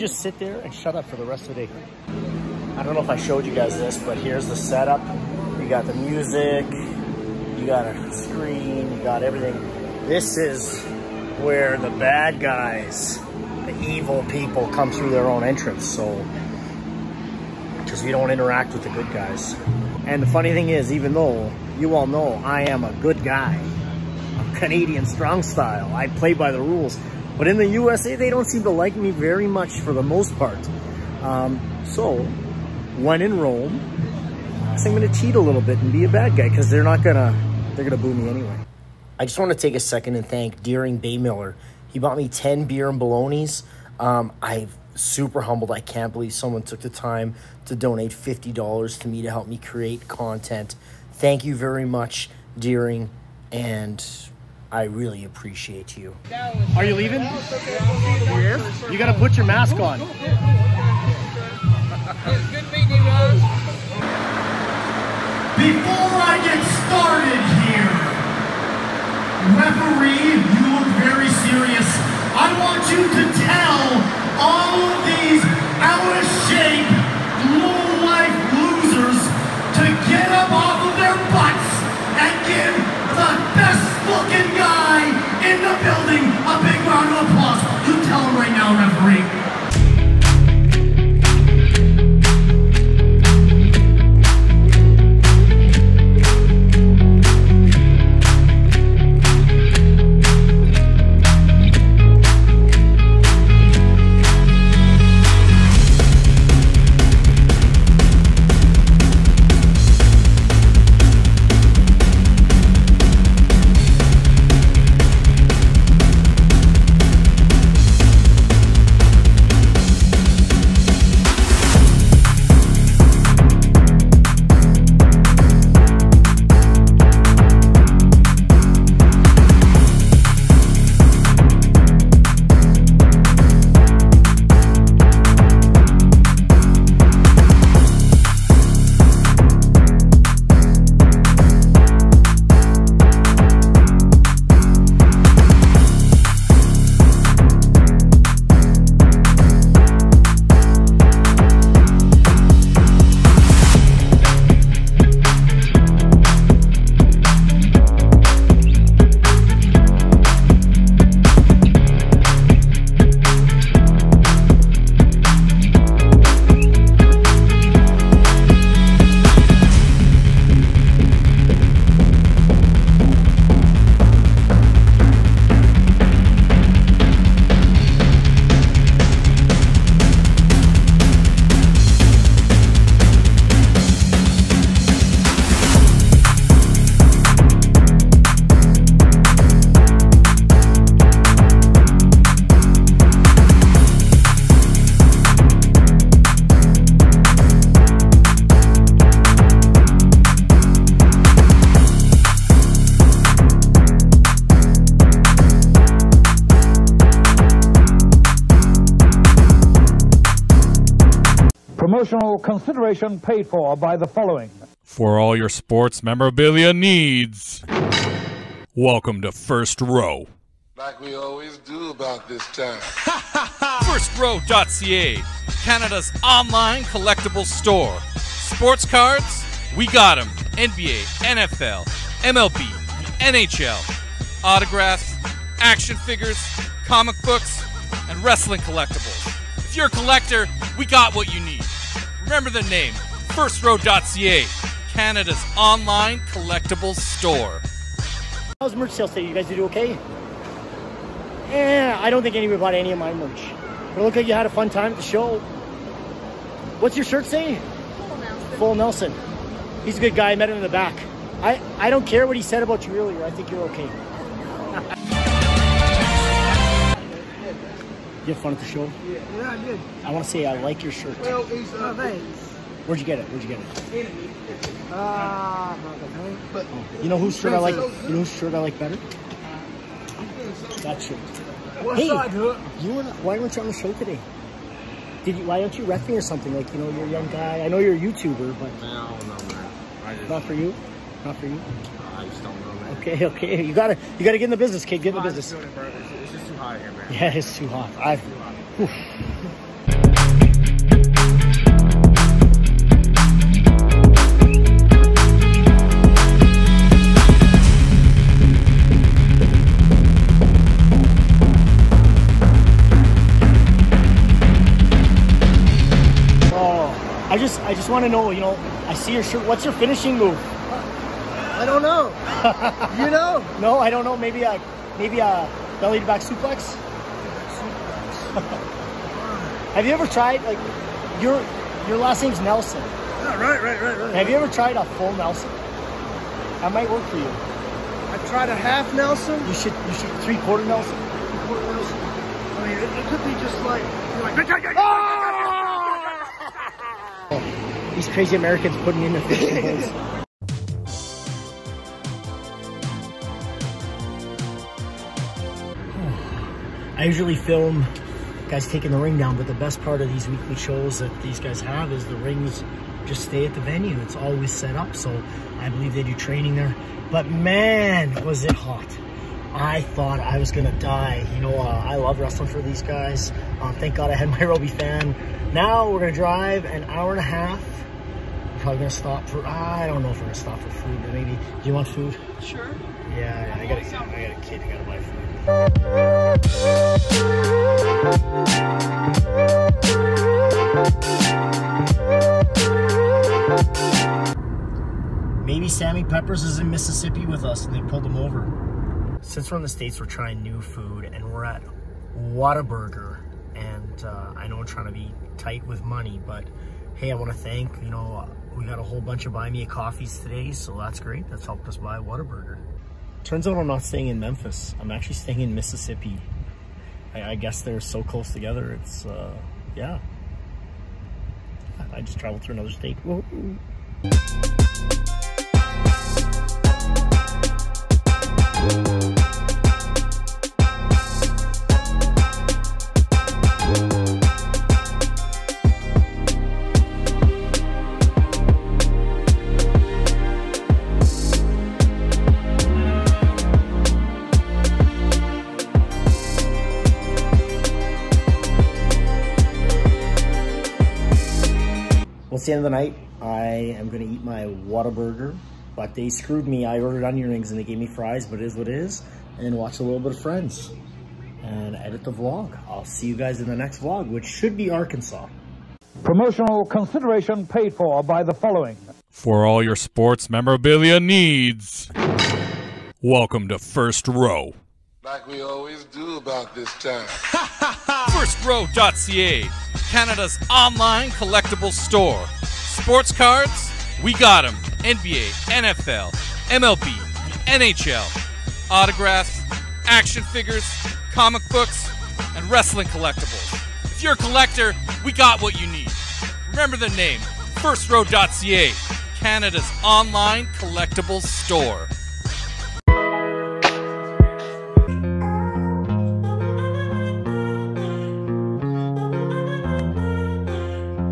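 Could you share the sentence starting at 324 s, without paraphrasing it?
Maybe a maybe a uh, Belly to back suplex?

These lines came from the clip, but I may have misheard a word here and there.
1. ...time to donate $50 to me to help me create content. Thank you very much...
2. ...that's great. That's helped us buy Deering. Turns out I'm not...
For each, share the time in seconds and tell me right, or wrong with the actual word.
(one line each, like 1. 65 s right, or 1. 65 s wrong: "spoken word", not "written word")
1. 46 s right
2. 410 s wrong: "Whataburger", not "Deering".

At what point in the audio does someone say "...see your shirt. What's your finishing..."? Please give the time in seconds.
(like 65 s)
318 s.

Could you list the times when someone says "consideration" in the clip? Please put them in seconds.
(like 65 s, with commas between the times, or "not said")
212 s, 466 s.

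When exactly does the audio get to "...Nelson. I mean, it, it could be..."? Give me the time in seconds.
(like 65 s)
341 s.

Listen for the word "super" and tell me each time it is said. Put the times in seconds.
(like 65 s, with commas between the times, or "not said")
44 s.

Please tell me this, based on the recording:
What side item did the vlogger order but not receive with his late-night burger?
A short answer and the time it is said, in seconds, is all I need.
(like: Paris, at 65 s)
Onion rings, at 457 s.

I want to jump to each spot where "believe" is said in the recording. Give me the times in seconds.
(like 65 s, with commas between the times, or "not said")
46 s, 365 s.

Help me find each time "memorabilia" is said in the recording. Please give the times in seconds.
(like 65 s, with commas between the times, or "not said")
216 s, 470 s.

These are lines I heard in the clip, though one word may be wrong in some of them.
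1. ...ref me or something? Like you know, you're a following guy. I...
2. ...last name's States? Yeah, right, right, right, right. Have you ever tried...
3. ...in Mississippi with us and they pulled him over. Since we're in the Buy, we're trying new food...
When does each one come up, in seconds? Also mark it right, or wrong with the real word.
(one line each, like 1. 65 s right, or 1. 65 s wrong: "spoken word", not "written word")
1. 285 s wrong: "young", not "following"
2. 331 s wrong: "Nelson", not "States"
3. 396 s wrong: "States", not "Buy".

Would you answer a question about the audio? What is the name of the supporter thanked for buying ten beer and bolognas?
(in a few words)
Deering Bay Miller.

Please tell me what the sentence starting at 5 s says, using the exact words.
You got the music, you got a screen, you got everything.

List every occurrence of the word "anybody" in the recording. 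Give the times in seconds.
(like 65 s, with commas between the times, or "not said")
252 s.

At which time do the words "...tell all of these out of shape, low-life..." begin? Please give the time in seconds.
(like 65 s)
73 s.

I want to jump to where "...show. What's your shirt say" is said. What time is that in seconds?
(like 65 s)
255 s.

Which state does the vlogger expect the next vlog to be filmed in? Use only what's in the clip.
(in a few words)
Arkansas.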